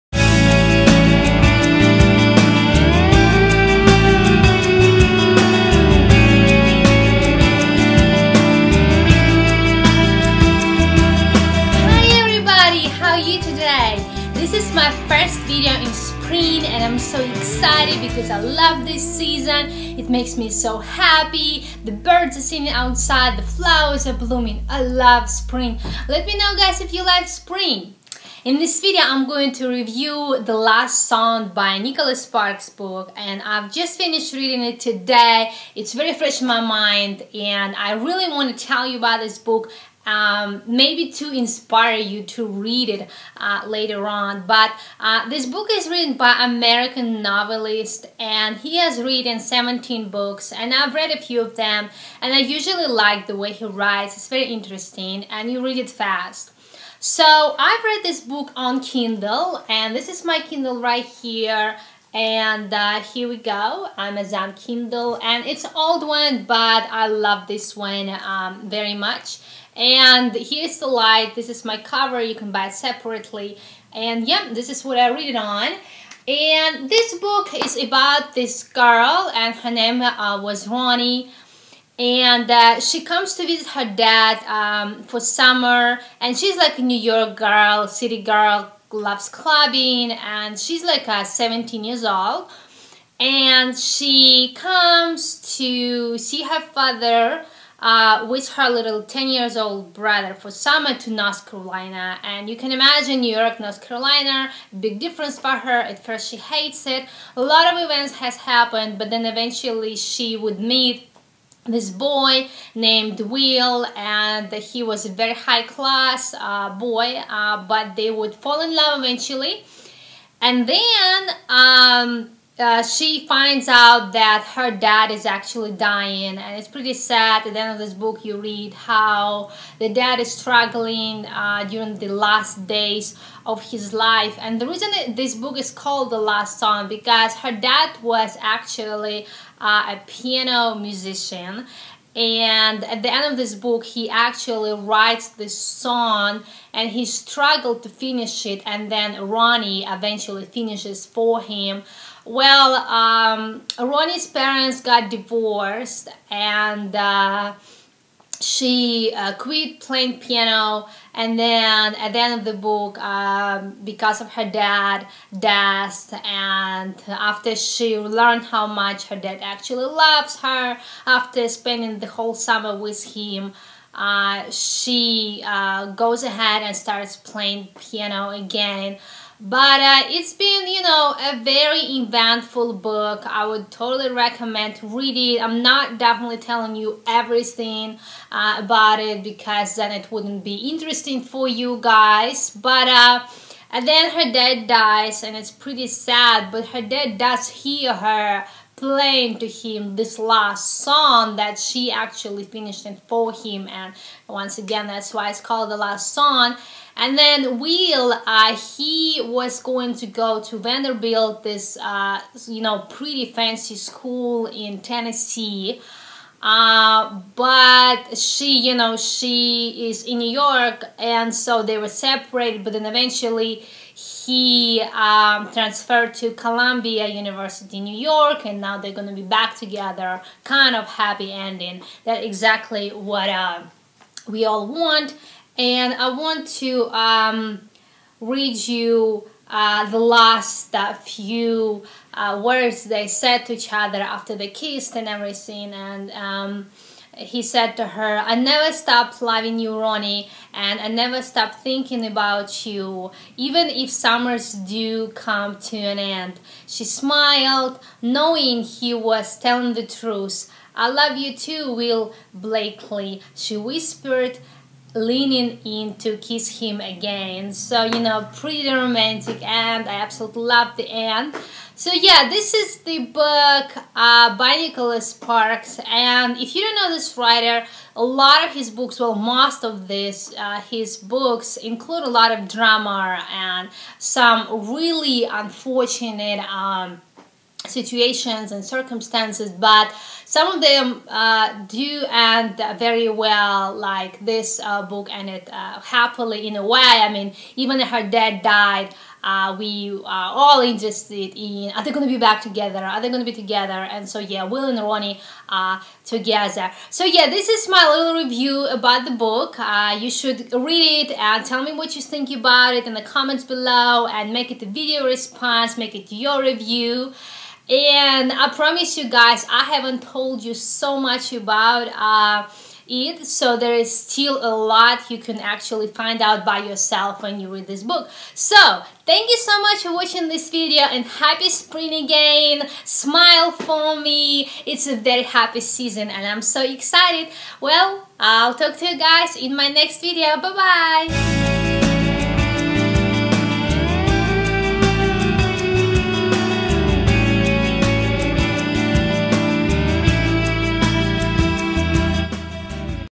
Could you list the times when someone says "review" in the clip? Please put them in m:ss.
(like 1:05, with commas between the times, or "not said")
0:29, 5:08, 5:16.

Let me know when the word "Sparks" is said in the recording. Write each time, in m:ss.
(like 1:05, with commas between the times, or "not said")
0:32, 4:35.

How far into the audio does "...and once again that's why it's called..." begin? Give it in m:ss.
3:23.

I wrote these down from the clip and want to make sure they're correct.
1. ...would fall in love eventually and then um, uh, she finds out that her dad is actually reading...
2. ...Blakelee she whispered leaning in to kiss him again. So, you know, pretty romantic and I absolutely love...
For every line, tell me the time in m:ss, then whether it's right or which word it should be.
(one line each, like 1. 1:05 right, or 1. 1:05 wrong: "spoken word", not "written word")
1. 1:58 wrong: "dying", not "reading"
2. 4:22 right.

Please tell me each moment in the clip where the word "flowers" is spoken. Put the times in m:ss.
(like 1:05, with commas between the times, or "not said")
0:23.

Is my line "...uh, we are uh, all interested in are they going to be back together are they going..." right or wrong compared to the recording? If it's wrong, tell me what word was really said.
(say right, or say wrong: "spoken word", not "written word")
right.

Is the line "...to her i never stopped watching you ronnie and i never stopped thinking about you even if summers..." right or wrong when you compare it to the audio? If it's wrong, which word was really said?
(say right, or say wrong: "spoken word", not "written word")
wrong: "loving", not "watching".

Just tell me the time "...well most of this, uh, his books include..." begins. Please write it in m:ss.
4:38.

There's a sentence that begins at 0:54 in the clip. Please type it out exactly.
It's very interesting and you read it fast.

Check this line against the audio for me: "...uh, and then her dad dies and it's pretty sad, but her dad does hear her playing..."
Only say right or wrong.
right.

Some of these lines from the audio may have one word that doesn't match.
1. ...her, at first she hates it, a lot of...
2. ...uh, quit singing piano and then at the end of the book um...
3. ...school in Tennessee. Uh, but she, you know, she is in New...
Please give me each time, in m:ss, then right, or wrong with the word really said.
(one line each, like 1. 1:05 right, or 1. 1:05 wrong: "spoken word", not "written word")
1. 1:45 right
2. 2:39 wrong: "playing", not "singing"
3. 3:33 right.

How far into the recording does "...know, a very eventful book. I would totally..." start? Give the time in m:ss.
3:00.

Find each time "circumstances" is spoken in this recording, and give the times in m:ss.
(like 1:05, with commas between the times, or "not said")
4:48.